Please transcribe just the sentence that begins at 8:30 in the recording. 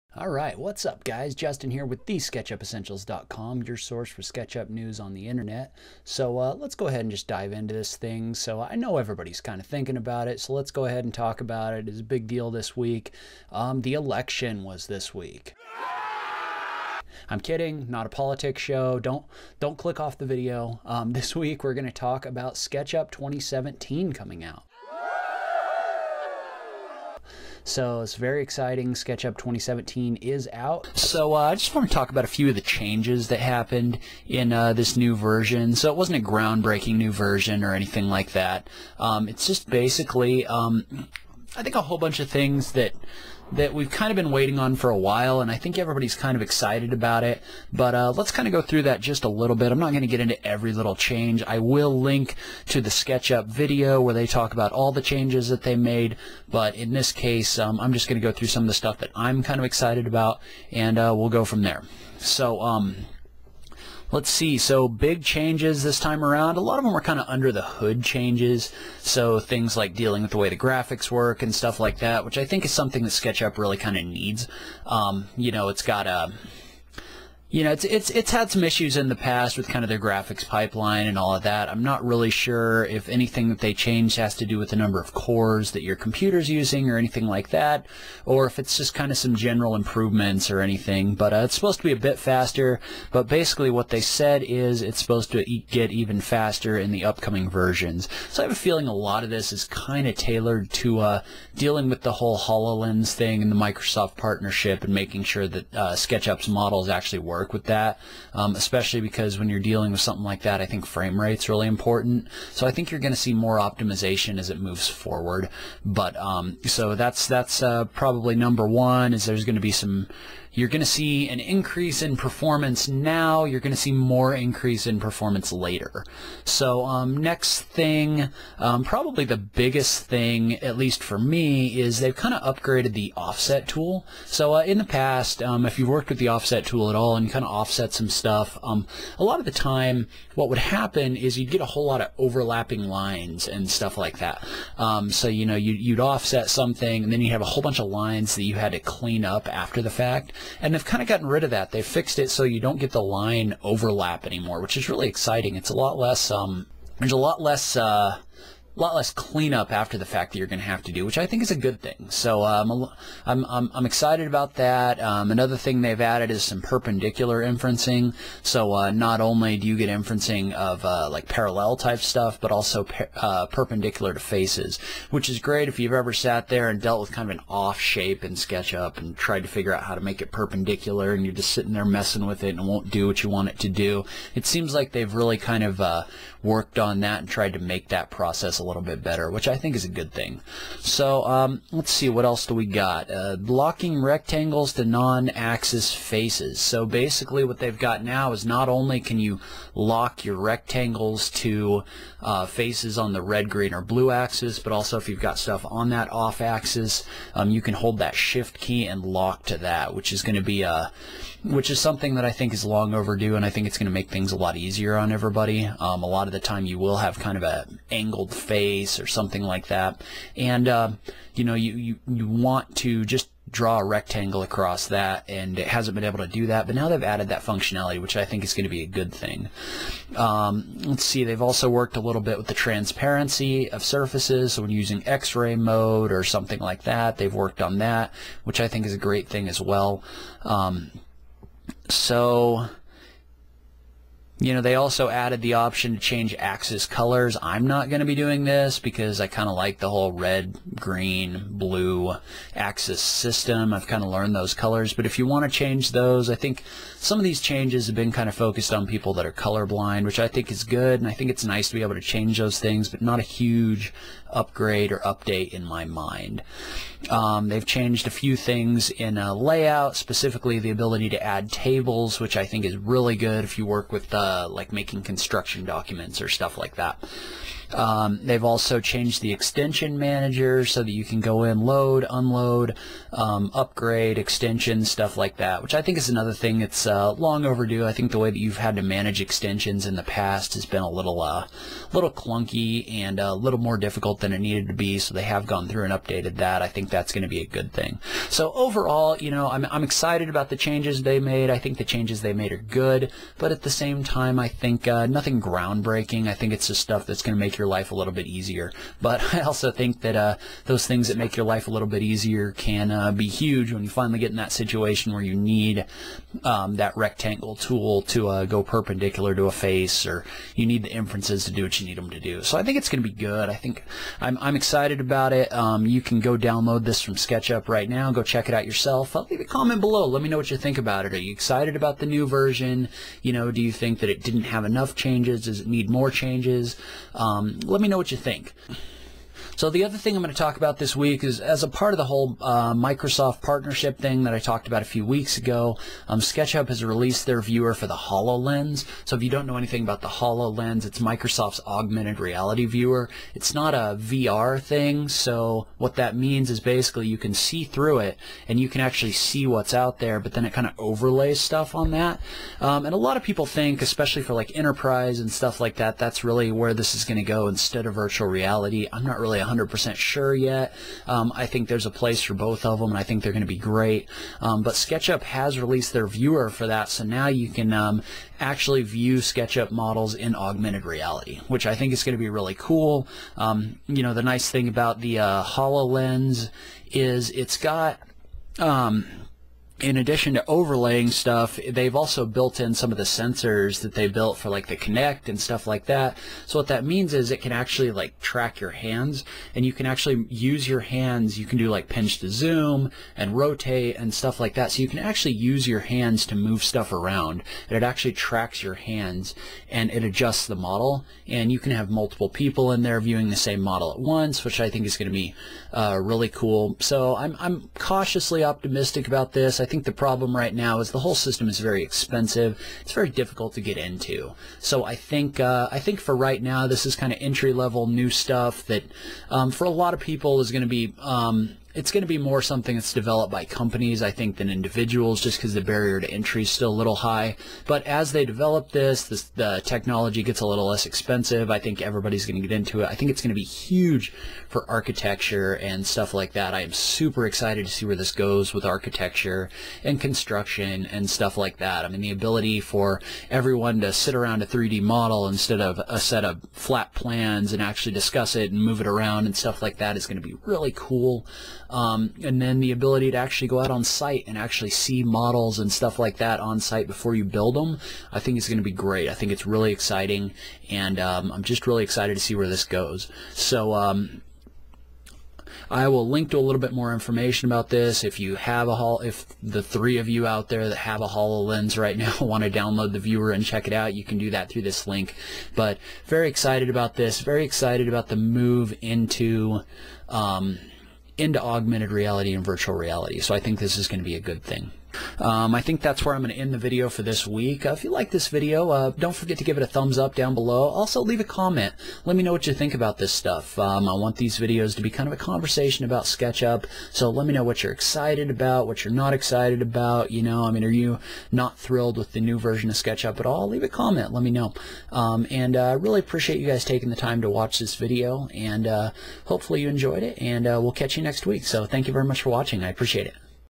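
You know, I mean, are you not thrilled with the new version of SketchUp at all?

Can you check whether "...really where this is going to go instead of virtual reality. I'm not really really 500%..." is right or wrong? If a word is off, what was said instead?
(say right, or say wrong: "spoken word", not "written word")
wrong: "100", not "500".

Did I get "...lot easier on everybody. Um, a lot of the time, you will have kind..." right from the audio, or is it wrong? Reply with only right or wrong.
right.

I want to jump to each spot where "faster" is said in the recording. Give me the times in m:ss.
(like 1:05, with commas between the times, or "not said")
1:32, 1:36.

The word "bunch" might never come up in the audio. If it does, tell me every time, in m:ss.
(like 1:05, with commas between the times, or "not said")
0:41, 2:27.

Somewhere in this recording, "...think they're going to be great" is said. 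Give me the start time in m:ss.
6:13.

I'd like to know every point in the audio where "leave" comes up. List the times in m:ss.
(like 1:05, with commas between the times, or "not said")
5:29, 8:21, 8:33.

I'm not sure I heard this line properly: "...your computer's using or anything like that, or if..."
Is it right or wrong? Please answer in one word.
right.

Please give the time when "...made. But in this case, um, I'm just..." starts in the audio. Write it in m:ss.
0:55.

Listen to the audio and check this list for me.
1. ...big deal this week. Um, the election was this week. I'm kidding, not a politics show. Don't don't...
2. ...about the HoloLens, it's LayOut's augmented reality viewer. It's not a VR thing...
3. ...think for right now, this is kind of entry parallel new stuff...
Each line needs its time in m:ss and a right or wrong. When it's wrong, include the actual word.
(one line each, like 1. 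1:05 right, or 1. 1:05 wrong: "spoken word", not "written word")
1. 0:12 right
2. 5:49 wrong: "Microsoft", not "LayOut"
3. 7:05 wrong: "level", not "parallel".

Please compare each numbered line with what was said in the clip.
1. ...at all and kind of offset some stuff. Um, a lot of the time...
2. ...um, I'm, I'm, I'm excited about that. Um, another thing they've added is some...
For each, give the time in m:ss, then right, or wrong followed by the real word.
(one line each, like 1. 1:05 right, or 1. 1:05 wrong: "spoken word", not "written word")
1. 2:16 right
2. 2:42 right.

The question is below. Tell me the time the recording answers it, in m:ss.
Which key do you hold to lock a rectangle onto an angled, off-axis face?
3:28.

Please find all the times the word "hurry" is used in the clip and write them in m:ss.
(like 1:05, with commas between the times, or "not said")
not said.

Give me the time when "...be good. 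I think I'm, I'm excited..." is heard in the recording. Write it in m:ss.
5:23.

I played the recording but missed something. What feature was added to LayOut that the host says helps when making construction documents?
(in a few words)
tables.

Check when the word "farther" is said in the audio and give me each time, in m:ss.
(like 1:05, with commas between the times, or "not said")
not said.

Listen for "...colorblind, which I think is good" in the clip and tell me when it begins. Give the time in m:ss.
4:19.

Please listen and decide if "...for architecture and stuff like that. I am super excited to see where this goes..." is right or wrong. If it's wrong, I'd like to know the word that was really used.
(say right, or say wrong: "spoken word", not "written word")
right.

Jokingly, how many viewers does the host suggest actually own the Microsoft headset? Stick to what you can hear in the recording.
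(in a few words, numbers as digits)
3.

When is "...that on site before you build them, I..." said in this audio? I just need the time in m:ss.
7:46.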